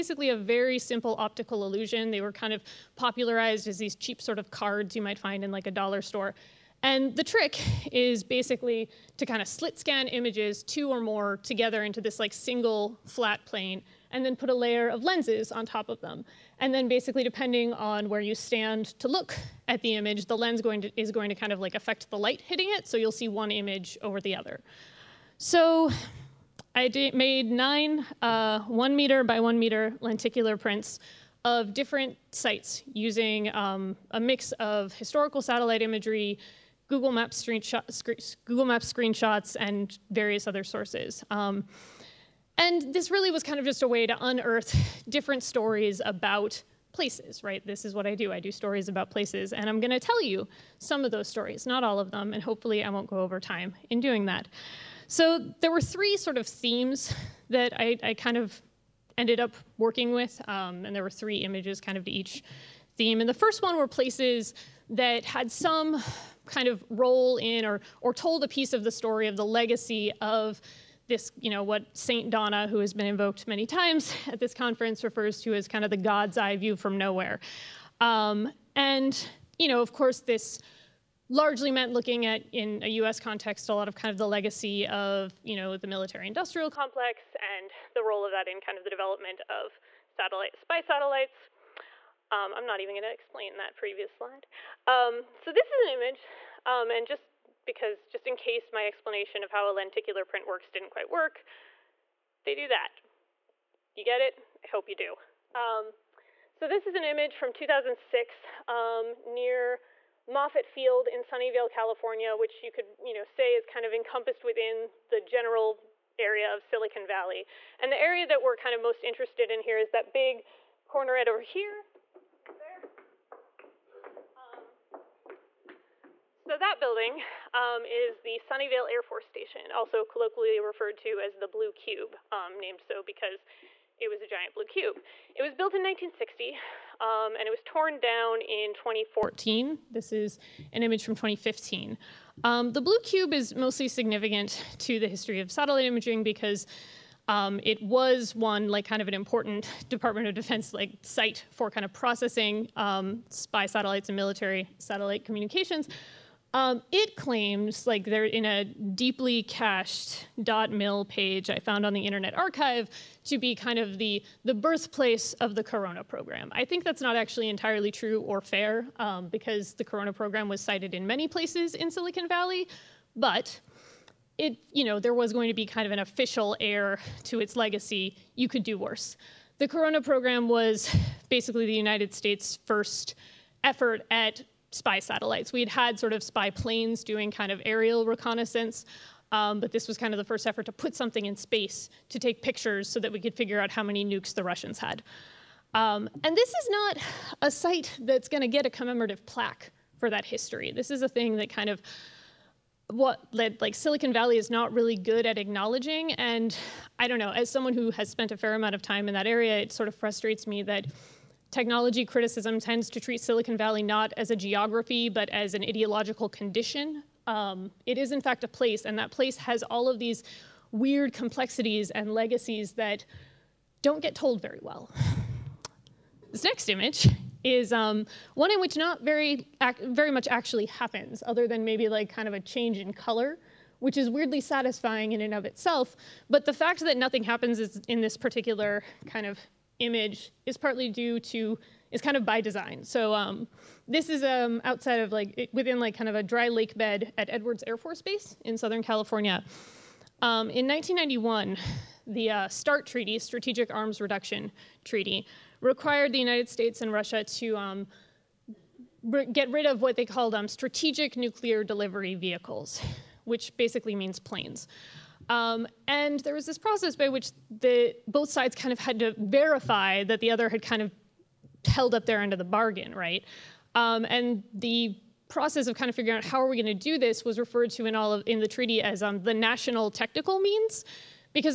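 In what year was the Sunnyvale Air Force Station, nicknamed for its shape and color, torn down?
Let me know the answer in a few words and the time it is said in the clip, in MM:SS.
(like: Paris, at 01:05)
2014, at 02:18.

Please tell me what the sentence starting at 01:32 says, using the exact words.
Um, I'm not even going to explain that previous slide.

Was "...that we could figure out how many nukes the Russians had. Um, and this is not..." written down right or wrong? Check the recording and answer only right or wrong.
right.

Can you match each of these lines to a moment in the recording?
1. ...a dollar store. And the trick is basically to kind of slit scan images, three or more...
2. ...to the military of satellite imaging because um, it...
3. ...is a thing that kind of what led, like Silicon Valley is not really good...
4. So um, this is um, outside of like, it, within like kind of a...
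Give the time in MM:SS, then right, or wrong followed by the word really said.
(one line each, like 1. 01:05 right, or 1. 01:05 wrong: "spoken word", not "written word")
1. 00:05 wrong: "two", not "three"
2. 02:24 wrong: "history", not "military"
3. 03:20 right
4. 04:02 right.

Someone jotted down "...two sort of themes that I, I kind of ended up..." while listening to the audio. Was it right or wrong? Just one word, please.
wrong.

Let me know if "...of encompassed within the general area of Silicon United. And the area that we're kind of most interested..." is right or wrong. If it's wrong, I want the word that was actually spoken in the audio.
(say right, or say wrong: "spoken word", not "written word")
wrong: "Valley", not "United".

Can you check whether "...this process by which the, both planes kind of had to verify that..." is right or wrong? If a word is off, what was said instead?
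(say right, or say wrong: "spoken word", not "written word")
wrong: "sides", not "planes".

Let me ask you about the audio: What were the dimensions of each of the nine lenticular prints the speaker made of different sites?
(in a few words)
1 meter by 1 meter.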